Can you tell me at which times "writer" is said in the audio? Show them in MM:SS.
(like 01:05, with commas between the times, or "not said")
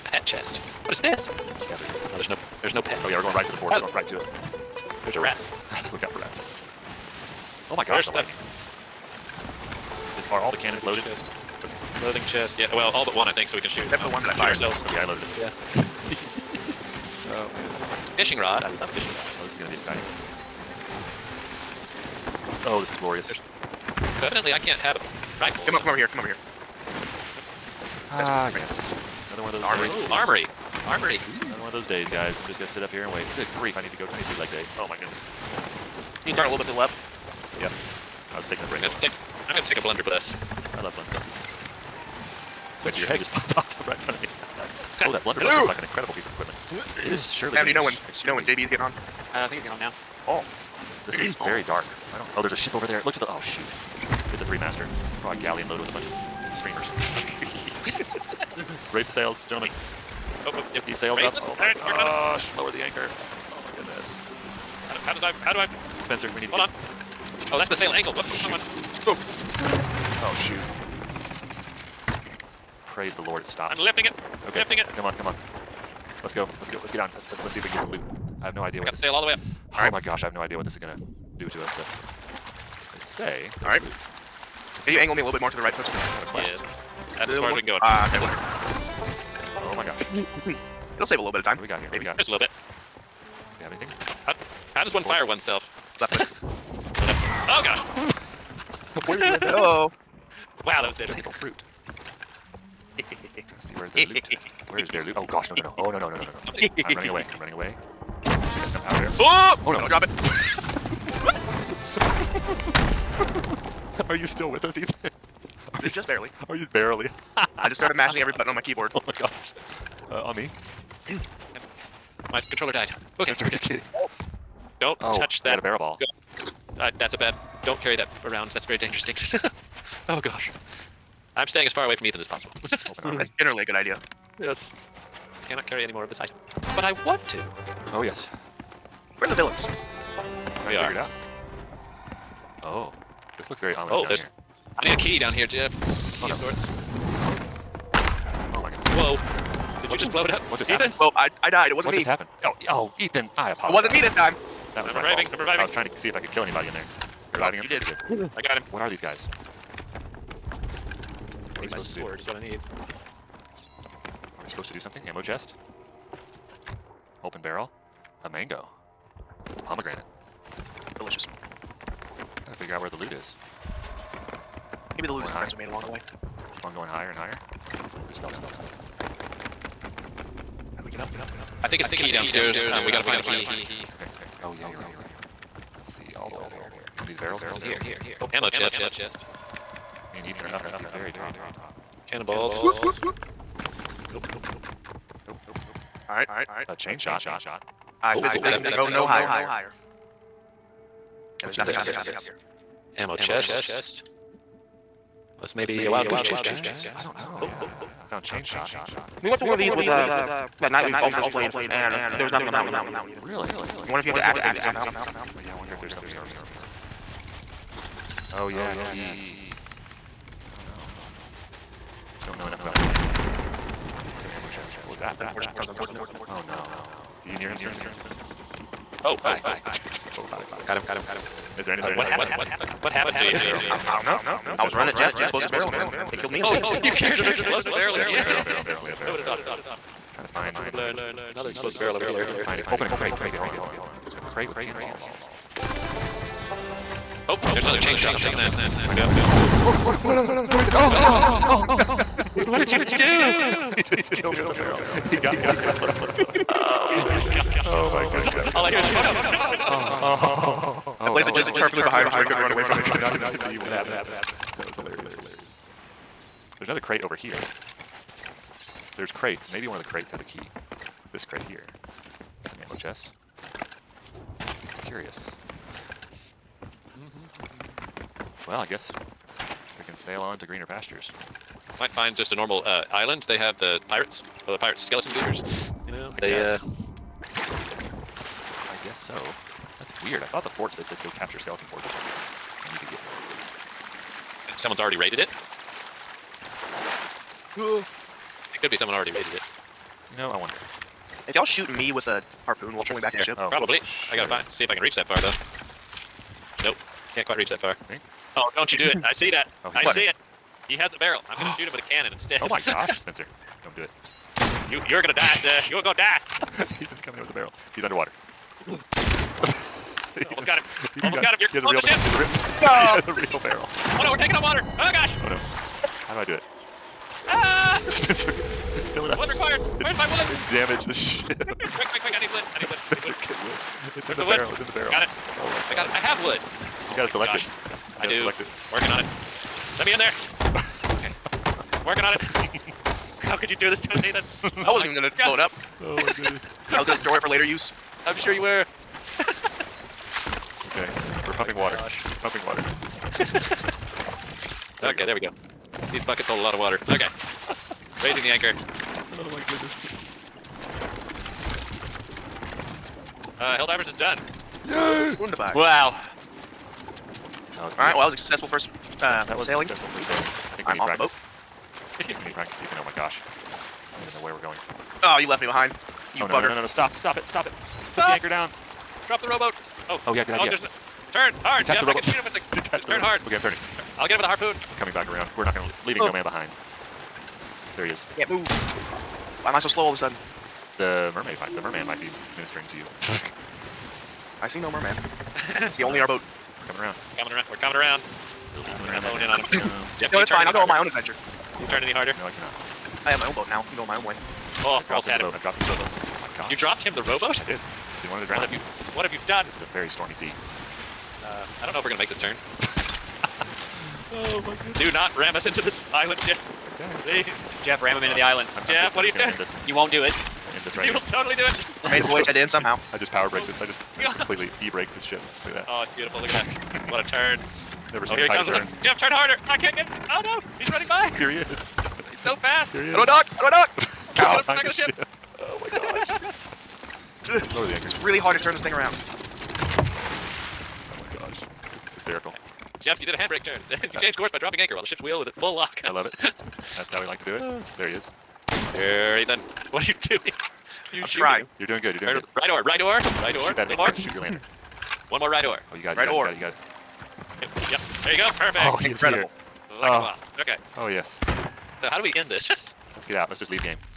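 not said.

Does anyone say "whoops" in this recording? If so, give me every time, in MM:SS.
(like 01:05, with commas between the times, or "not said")
01:00, 01:08, 03:12.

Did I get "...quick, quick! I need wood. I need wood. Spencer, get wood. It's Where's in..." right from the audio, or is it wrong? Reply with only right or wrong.
right.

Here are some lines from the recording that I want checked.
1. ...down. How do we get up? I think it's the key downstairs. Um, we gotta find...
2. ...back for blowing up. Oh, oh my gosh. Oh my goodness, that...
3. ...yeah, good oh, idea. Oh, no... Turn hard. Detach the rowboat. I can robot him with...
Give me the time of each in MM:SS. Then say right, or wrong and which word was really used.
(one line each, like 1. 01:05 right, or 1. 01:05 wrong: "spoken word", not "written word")
1. 02:58 right
2. 04:15 right
3. 06:20 wrong: "shoot", not "robot".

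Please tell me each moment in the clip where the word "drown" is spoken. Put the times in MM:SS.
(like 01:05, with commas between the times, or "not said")
06:48.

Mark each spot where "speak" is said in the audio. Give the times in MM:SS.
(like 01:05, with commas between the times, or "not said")
not said.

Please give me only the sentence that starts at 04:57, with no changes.
It could be someone already raided it.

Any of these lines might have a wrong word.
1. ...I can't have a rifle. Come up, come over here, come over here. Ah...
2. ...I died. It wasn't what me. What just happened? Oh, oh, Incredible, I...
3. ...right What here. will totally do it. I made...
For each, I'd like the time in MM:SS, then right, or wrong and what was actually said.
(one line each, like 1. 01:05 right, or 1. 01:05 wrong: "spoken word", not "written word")
1. 00:24 right
2. 02:31 wrong: "Ethan", not "Incredible"
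3. 07:00 wrong: "You", not "What".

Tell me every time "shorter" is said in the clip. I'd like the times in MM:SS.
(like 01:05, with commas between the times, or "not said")
not said.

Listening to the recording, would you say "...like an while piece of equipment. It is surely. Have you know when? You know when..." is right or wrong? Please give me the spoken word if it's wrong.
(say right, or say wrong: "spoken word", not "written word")
wrong: "incredible", not "while".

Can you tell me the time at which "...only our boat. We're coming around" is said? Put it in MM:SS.
06:35.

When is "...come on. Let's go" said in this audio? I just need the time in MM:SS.
01:15.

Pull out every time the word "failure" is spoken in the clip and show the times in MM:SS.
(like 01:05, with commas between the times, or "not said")
not said.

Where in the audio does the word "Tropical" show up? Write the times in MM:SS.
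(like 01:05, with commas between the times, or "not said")
01:41.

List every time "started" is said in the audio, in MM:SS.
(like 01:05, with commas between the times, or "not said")
01:57.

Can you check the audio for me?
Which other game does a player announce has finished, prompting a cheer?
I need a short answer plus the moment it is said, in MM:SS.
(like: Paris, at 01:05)
Helldivers, at 06:03.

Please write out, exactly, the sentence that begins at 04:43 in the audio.
They have the pirates, the pirate skeleton goobers.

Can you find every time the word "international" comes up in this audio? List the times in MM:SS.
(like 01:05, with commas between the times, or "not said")
not said.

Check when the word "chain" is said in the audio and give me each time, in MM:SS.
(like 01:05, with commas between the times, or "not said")
03:16, 03:28, 04:07.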